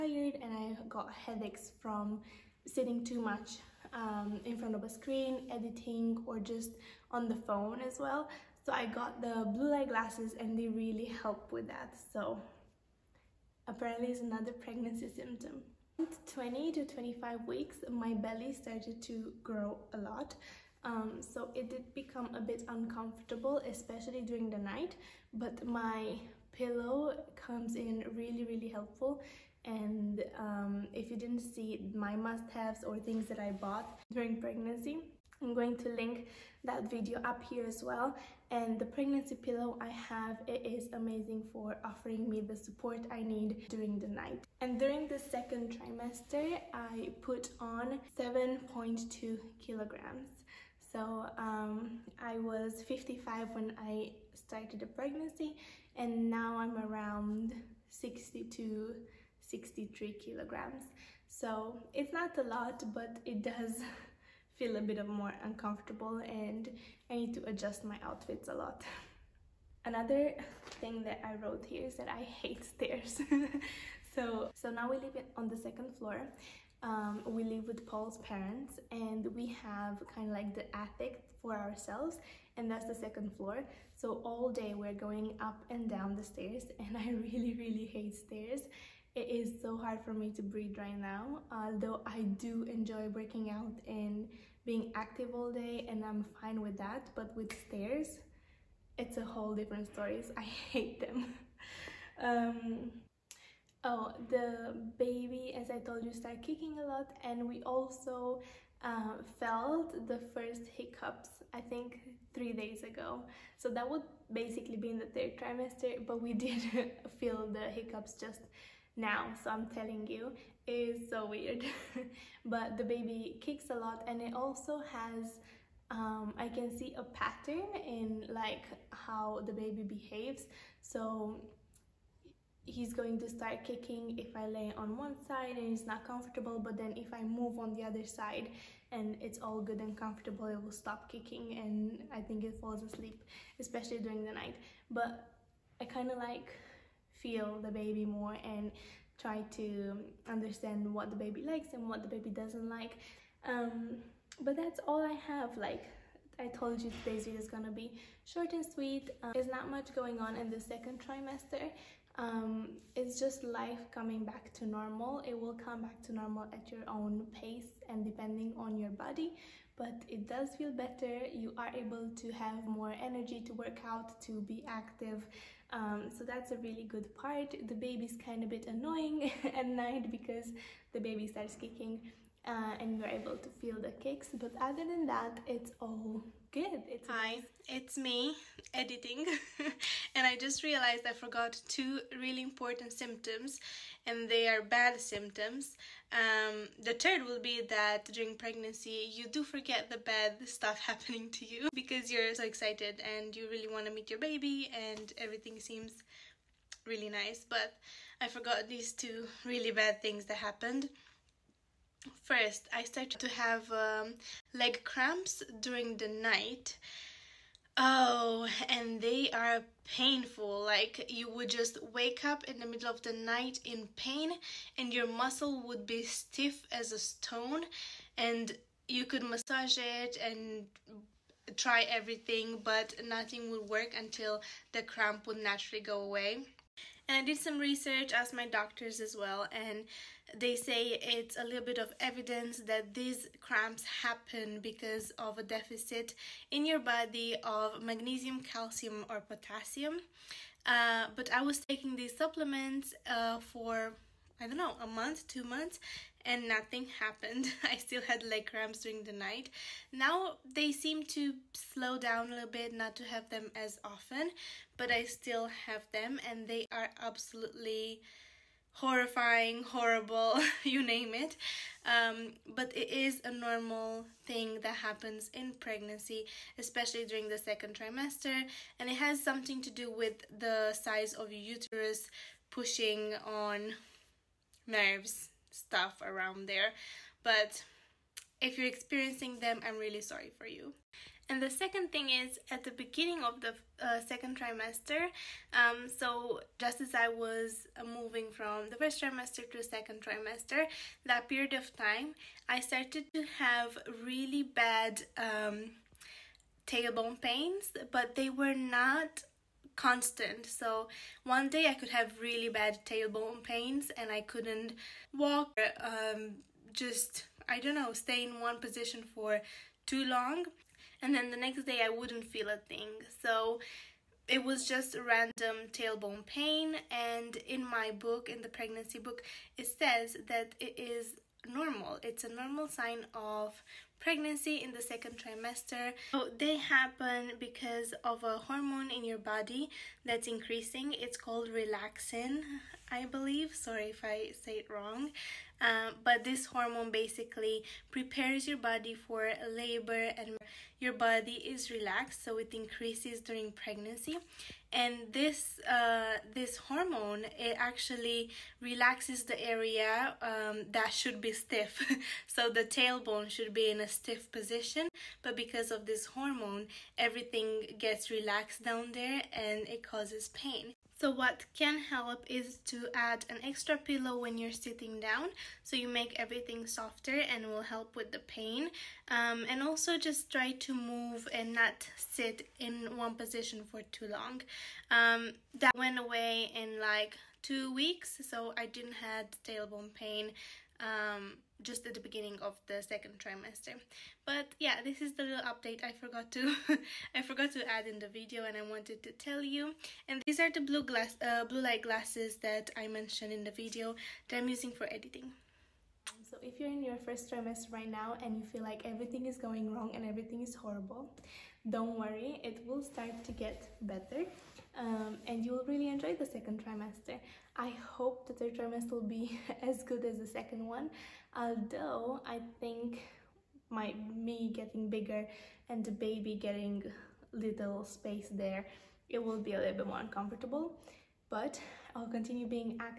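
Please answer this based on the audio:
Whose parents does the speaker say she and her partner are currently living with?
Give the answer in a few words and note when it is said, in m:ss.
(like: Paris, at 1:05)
Paul's parents, at 1:17.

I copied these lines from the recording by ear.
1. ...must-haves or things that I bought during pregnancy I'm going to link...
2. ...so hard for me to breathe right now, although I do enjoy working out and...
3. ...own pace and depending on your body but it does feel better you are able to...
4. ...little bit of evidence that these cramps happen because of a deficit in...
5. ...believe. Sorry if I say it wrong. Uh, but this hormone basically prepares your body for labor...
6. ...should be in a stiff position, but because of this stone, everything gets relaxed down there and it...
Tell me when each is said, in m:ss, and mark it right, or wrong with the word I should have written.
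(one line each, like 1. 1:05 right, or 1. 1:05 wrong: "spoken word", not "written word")
1. 0:32 right
2. 1:29 right
3. 2:46 right
4. 4:01 right
5. 5:43 right
6. 6:03 wrong: "hormone", not "stone".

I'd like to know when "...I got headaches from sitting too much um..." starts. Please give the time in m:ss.
0:00.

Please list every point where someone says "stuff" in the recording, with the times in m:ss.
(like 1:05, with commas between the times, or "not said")
3:20, 4:45.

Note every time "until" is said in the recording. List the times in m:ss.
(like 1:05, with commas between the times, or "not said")
3:53.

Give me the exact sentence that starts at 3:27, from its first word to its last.
But I forgot these two really bad things that happened.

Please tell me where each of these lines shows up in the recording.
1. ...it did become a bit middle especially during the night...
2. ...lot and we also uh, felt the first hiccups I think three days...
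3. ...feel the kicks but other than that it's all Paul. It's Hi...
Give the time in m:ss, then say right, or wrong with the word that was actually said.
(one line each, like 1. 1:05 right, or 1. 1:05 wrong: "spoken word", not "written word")
1. 0:21 wrong: "uncomfortable", not "middle"
2. 1:46 right
3. 3:03 wrong: "Good", not "Paul".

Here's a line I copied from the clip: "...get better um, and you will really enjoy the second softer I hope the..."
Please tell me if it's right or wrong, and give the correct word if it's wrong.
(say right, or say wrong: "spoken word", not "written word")
wrong: "trimester", not "softer".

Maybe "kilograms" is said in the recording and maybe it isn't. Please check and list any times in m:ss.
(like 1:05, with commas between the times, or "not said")
0:49, 1:00.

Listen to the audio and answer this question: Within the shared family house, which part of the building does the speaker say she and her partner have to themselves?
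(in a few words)
The attic.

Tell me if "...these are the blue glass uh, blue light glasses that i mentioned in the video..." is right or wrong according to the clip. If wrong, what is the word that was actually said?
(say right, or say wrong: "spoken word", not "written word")
right.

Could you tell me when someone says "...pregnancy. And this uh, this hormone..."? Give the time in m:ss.
5:53.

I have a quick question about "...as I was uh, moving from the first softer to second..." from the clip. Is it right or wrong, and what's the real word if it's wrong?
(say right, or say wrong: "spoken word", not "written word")
wrong: "trimester", not "softer".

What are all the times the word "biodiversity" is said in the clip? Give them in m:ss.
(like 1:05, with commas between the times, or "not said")
not said.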